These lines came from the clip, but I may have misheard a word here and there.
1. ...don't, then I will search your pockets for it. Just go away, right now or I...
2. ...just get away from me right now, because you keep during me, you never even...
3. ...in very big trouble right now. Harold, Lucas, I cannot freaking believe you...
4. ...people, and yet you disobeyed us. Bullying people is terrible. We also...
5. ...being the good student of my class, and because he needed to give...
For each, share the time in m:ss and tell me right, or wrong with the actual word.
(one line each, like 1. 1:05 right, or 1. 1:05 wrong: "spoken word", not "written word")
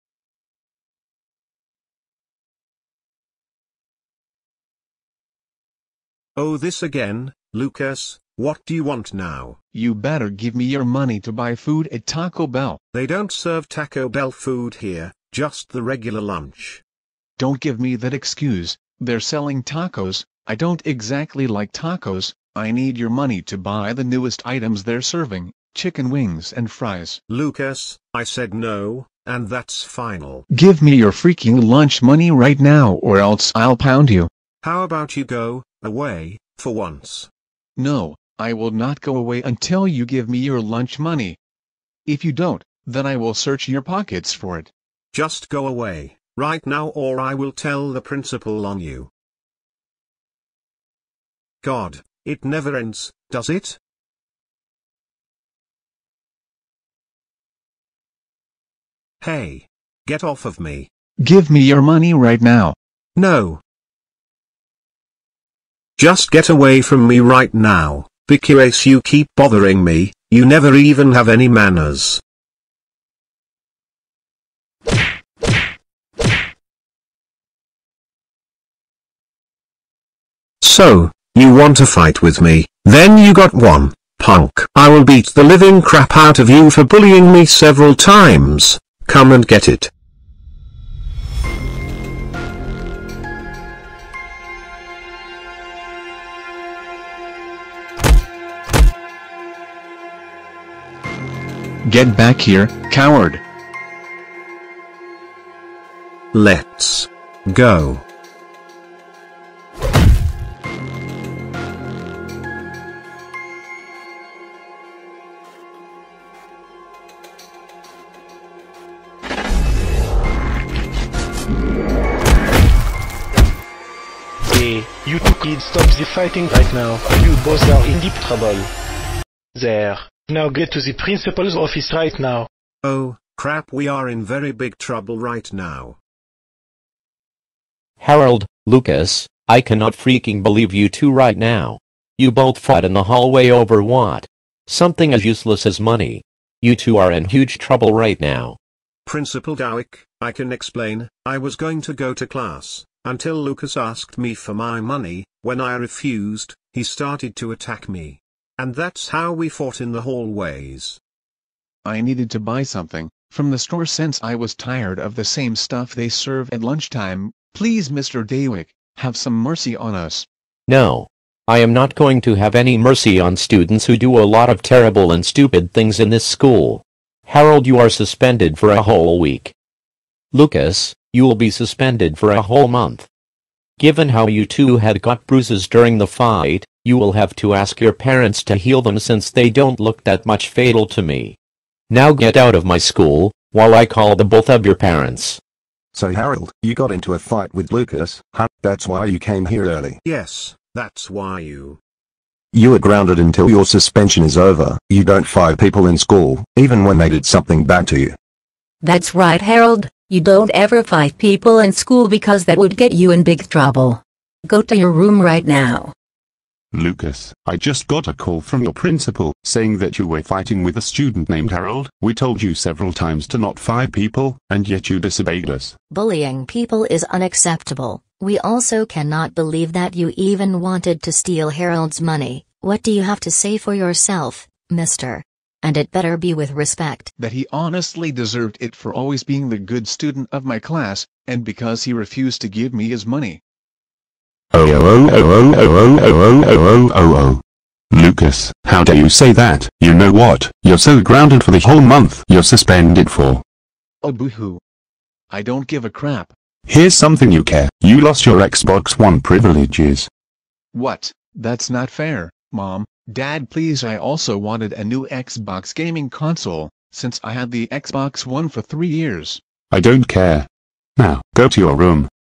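1. 0:42 right
2. 1:06 wrong: "bothering", not "during"
3. 2:14 right
4. 3:43 wrong: "unacceptable", not "terrible"
5. 3:59 wrong: "refused", not "needed".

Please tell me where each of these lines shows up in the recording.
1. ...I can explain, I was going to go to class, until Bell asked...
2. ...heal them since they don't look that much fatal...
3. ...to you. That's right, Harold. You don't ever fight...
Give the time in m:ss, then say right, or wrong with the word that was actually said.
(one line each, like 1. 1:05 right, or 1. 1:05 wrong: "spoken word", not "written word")
1. 2:30 wrong: "Lucas", not "Bell"
2. 3:08 right
3. 3:27 right.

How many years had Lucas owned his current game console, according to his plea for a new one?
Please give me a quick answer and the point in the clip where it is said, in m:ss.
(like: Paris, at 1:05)
3, at 4:28.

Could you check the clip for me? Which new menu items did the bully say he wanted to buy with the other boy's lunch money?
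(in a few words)
chicken wings and fries.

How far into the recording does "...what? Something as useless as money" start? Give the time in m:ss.
2:23.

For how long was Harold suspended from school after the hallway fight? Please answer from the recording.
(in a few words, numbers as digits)
a whole week.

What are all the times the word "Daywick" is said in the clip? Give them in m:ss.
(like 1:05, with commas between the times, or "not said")
2:48.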